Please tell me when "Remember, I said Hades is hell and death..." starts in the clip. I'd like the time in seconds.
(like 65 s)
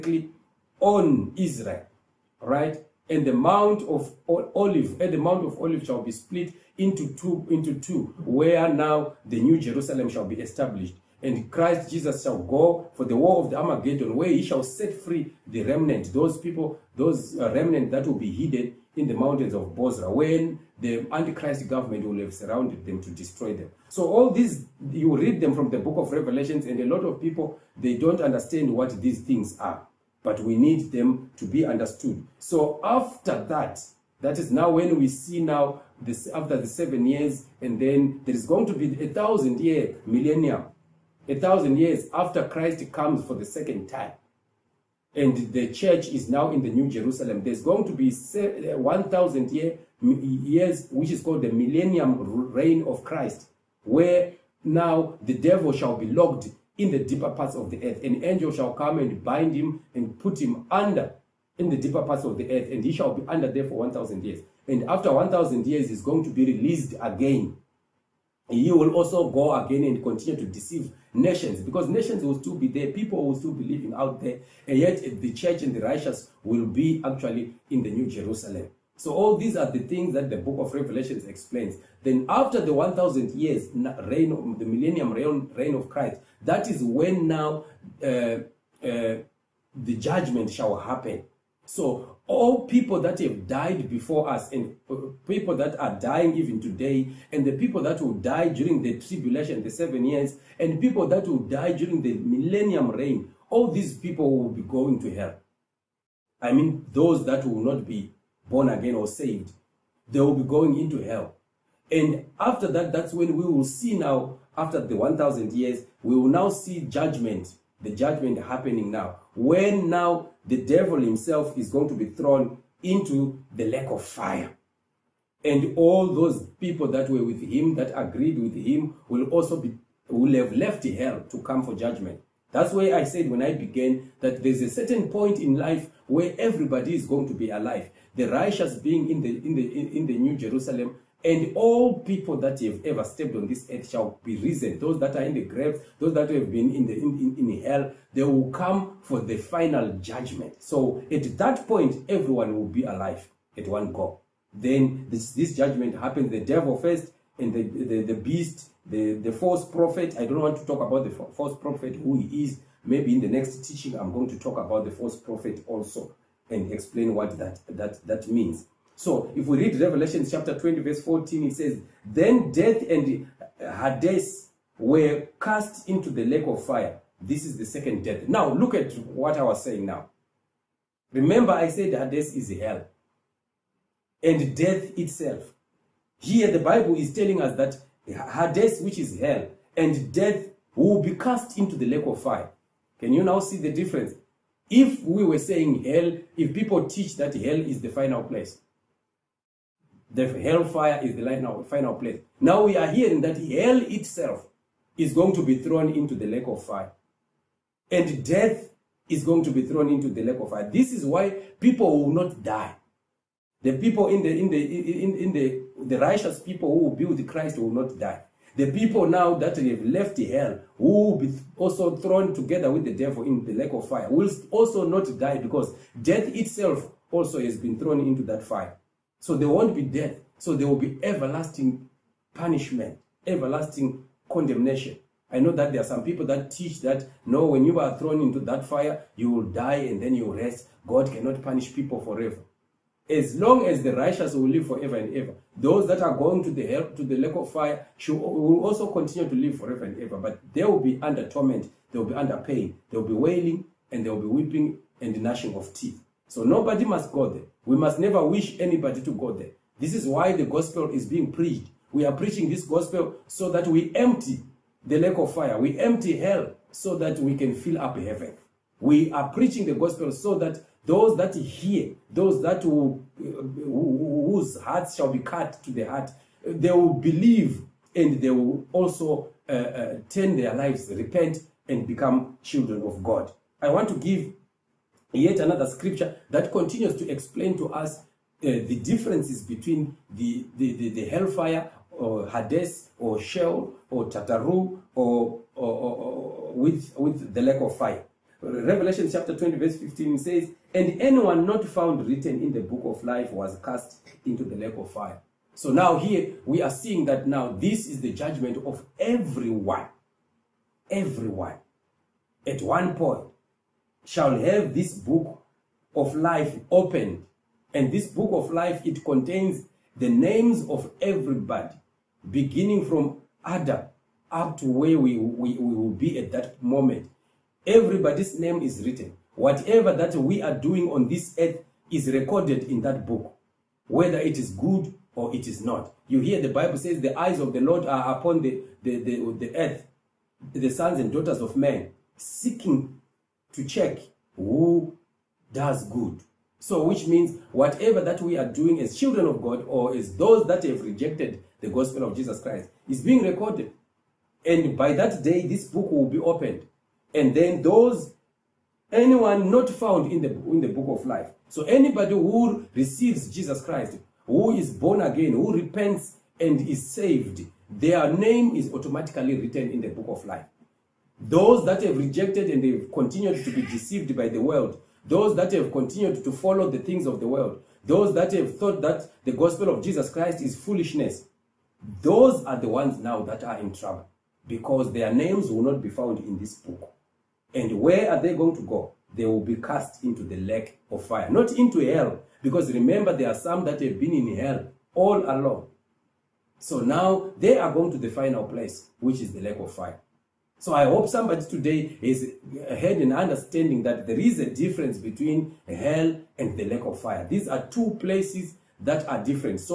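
181 s.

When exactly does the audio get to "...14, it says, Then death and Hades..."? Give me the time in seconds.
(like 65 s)
171 s.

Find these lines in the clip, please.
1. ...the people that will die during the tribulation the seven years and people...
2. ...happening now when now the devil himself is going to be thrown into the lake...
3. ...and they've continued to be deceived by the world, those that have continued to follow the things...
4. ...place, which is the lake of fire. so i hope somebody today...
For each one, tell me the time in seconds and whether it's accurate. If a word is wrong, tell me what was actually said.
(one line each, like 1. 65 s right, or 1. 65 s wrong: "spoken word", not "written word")
1. 97 s right
2. 118 s right
3. 372 s right
4. 398 s right.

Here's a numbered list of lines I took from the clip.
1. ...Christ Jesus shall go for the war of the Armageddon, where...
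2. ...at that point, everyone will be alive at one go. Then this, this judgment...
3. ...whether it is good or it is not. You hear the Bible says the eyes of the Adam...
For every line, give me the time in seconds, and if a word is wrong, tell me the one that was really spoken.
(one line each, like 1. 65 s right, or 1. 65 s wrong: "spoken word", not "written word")
1. 11 s right
2. 151 s right
3. 333 s wrong: "Lord", not "Adam".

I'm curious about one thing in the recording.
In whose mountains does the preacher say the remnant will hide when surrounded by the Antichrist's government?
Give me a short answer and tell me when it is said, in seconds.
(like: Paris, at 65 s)
Bozrah, at 19 s.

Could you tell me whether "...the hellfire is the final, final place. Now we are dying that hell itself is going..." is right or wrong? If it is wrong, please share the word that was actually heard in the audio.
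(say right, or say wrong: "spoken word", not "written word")
wrong: "hearing", not "dying".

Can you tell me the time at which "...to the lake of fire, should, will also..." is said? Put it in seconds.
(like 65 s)
246 s.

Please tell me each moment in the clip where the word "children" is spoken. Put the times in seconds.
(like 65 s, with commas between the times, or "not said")
282 s, 348 s.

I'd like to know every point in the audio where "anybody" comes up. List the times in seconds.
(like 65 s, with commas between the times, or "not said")
258 s, 361 s.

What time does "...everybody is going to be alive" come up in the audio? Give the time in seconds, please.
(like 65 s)
136 s.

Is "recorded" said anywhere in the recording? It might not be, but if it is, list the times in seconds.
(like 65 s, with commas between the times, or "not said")
332 s, 353 s.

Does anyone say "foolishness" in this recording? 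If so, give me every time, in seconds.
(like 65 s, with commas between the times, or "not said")
380 s.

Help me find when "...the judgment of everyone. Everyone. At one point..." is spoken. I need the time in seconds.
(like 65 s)
307 s.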